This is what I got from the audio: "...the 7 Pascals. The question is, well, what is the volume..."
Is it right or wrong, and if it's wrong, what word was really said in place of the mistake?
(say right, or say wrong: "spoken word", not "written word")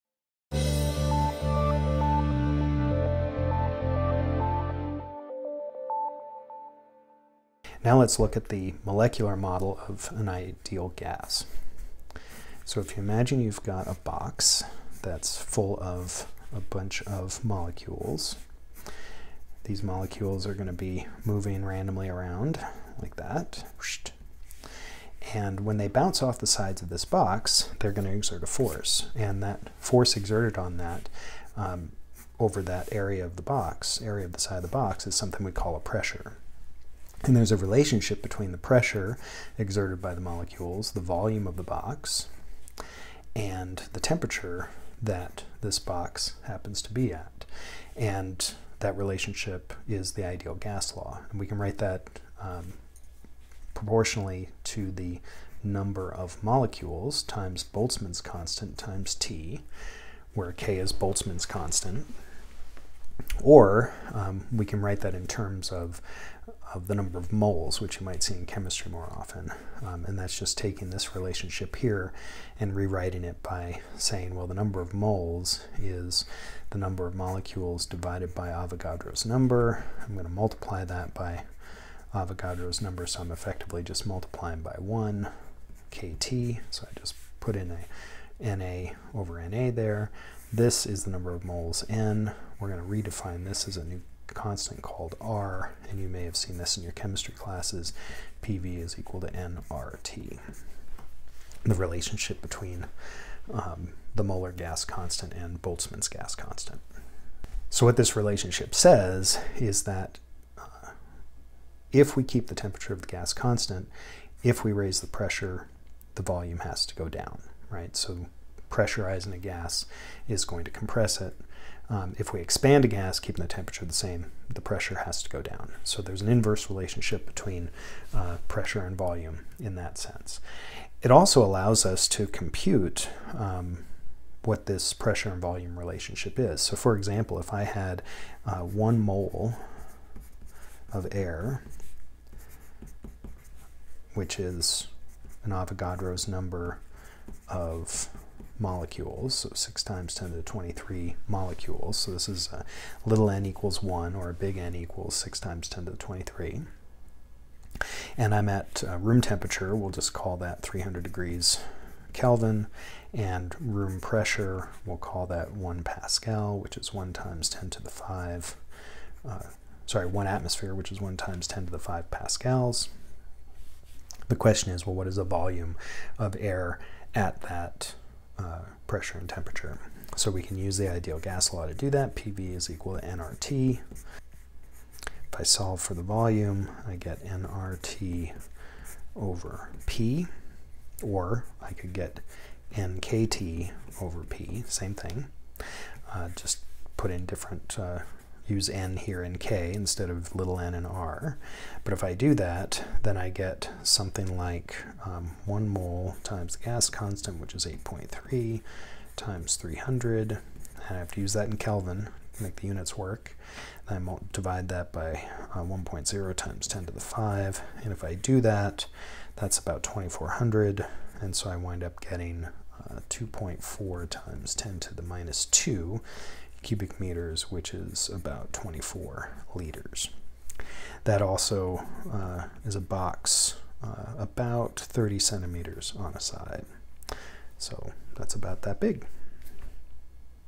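wrong: "5", not "7".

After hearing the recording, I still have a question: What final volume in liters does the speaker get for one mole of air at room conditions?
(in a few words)
24 liters.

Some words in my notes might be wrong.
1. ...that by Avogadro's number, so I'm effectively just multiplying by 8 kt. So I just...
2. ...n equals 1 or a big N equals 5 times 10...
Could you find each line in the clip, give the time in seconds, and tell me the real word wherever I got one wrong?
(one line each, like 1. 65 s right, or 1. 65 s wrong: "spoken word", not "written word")
1. 80 s wrong: "1", not "8"
2. 153 s wrong: "6", not "5".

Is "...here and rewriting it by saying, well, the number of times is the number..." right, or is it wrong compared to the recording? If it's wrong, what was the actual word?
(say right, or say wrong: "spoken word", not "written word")
wrong: "moles", not "times".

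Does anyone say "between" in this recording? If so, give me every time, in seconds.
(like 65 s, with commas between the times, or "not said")
38 s, 102 s, 127 s.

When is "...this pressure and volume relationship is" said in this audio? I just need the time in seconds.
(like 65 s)
134 s.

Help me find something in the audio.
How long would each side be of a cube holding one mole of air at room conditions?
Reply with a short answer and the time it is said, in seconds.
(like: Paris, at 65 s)
30 centimeters, at 234 s.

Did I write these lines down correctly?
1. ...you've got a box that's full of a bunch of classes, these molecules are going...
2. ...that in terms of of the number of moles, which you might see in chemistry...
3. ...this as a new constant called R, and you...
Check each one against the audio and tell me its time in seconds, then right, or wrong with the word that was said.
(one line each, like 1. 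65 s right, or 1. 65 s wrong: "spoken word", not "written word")
1. 13 s wrong: "molecules", not "classes"
2. 65 s right
3. 93 s right.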